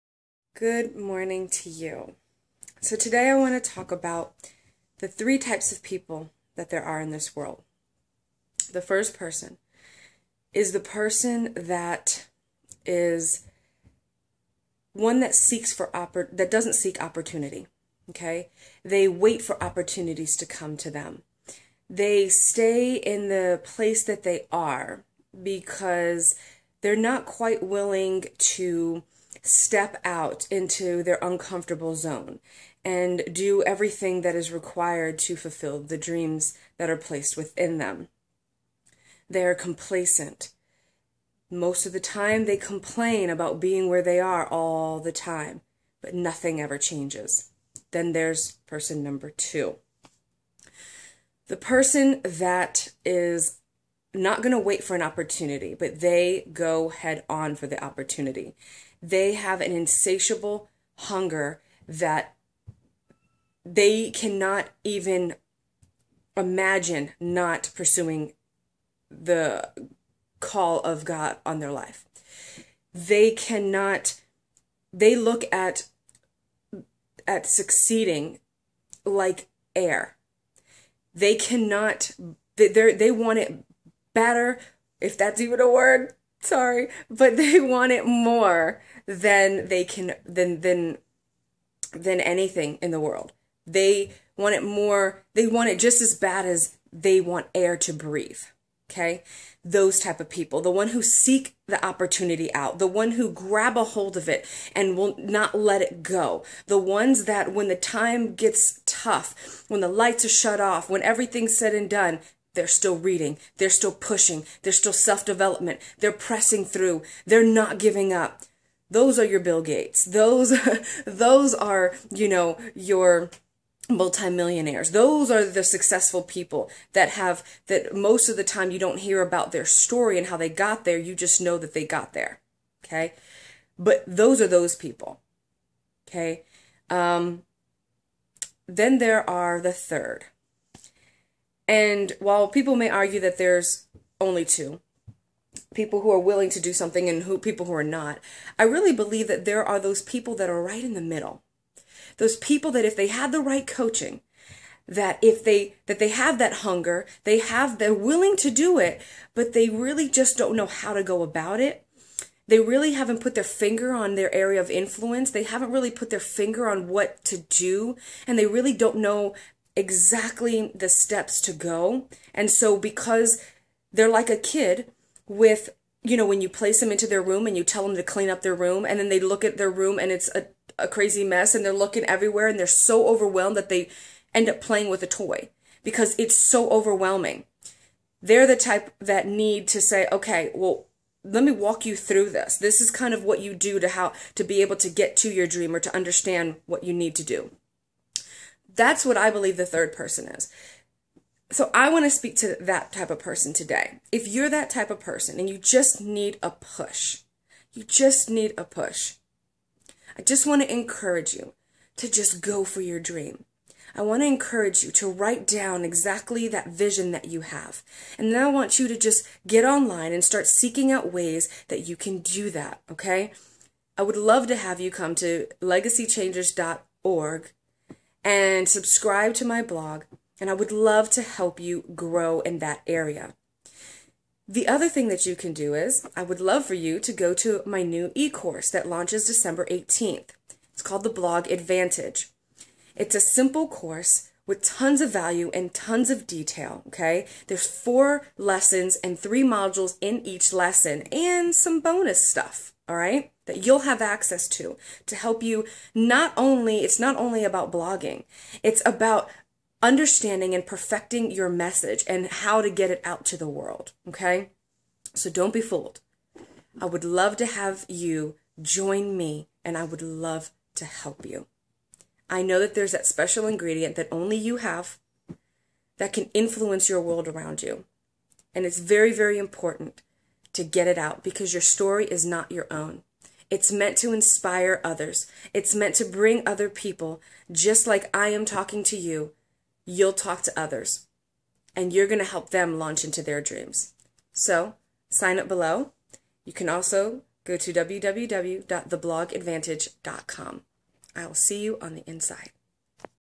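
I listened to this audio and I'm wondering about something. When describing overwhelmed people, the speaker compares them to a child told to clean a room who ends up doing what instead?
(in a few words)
playing with a toy.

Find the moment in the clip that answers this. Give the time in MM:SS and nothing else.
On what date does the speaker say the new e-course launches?
03:59.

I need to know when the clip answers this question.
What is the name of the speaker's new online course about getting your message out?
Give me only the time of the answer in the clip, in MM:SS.
04:01.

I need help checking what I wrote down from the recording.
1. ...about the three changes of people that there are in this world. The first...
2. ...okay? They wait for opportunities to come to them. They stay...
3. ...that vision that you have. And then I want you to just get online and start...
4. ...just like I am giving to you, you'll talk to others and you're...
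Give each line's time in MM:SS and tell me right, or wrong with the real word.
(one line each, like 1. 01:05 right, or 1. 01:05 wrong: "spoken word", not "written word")
1. 00:03 wrong: "types", not "changes"
2. 00:18 right
3. 03:36 right
4. 04:47 wrong: "talking", not "giving".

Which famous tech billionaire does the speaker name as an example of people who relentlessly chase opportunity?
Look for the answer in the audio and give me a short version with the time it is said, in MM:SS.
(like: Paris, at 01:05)
Bill Gates, at 01:59.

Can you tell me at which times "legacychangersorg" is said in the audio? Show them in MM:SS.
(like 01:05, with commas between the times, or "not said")
03:45.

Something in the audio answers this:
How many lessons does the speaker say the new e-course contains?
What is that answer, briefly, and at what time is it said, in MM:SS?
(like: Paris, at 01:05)
4, at 04:07.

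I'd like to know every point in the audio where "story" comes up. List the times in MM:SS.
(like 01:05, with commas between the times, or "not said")
02:09, 04:41.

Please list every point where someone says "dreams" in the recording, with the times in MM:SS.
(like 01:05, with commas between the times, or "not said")
00:35, 03:15, 03:32, 04:53.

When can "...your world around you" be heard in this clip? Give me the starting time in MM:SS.
04:36.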